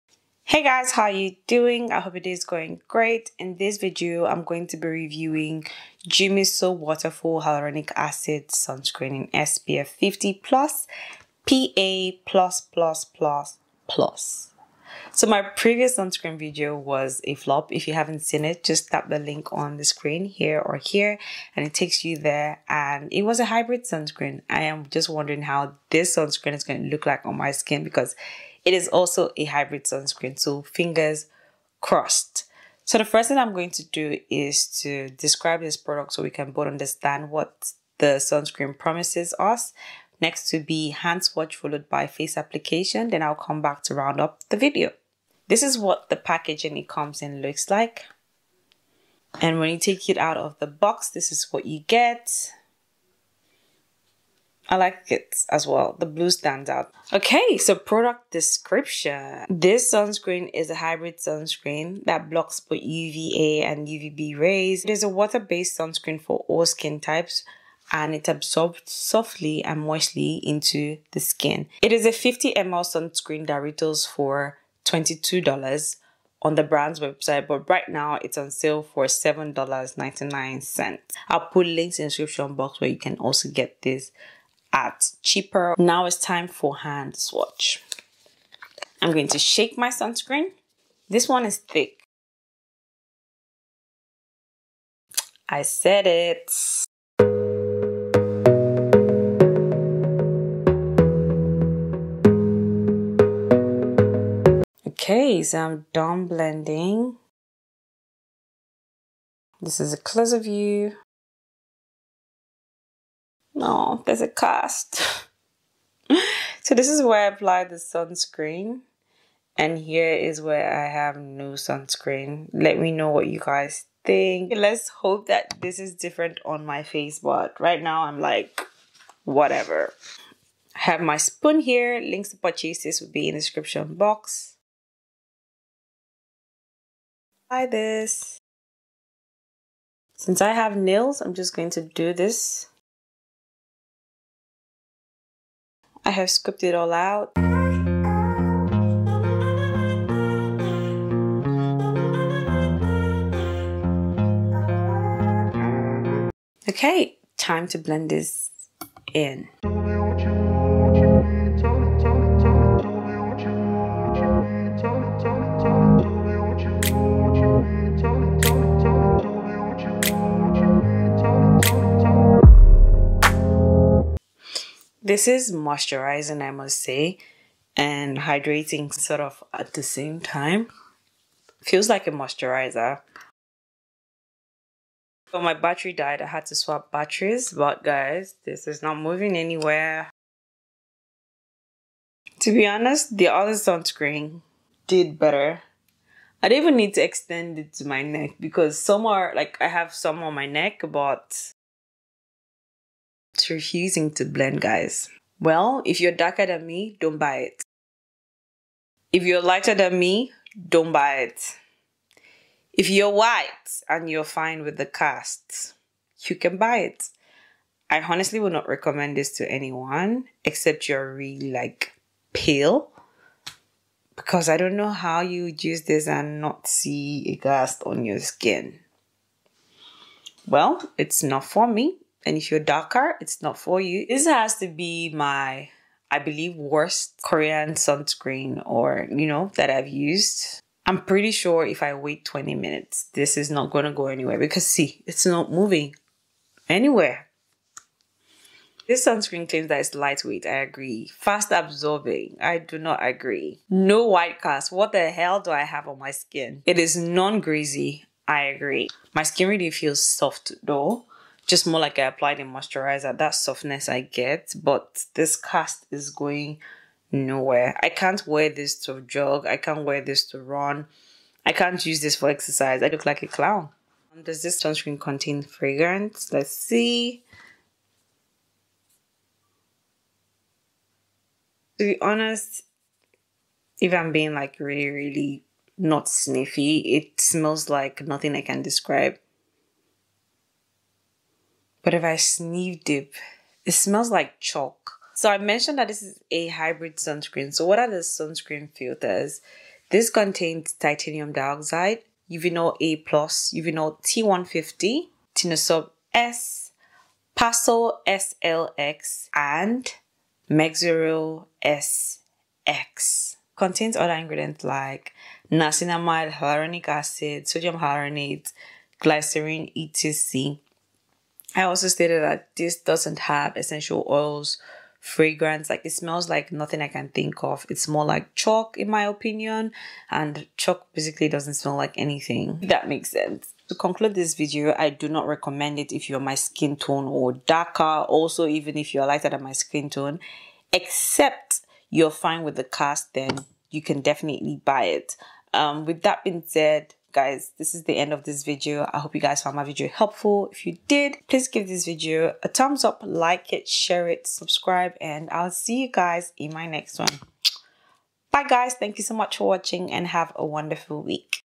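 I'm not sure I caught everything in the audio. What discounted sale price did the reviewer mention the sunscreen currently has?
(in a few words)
$7.99.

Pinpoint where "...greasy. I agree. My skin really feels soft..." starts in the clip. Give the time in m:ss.
4:17.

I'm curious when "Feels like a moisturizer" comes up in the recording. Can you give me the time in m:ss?
3:01.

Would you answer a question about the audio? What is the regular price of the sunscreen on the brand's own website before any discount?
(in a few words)
$22.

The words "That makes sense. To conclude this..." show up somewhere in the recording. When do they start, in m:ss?
5:32.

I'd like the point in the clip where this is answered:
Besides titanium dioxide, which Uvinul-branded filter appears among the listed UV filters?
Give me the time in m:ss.
5:02.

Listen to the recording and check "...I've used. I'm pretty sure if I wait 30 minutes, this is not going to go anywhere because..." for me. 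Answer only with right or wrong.
wrong.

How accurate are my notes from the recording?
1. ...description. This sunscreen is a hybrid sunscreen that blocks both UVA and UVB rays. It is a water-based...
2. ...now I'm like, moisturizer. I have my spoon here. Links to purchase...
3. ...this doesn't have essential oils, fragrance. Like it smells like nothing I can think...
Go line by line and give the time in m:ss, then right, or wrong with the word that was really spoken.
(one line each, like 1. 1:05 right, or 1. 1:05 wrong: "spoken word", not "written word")
1. 0:58 right
2. 2:07 wrong: "whatever", not "moisturizer"
3. 5:22 right.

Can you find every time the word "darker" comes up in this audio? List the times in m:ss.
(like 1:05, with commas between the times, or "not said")
3:26, 3:52, 5:37.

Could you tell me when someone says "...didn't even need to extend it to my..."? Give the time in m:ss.
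3:16.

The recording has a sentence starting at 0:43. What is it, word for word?
Then I'll come back to round up the video.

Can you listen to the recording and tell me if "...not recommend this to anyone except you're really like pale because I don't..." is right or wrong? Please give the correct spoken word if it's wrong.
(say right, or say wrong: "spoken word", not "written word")
right.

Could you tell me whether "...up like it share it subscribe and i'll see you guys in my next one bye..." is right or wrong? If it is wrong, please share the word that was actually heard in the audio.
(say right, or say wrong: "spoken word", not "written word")
right.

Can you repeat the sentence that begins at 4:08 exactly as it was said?
This sunscreen claims that it's lightweight.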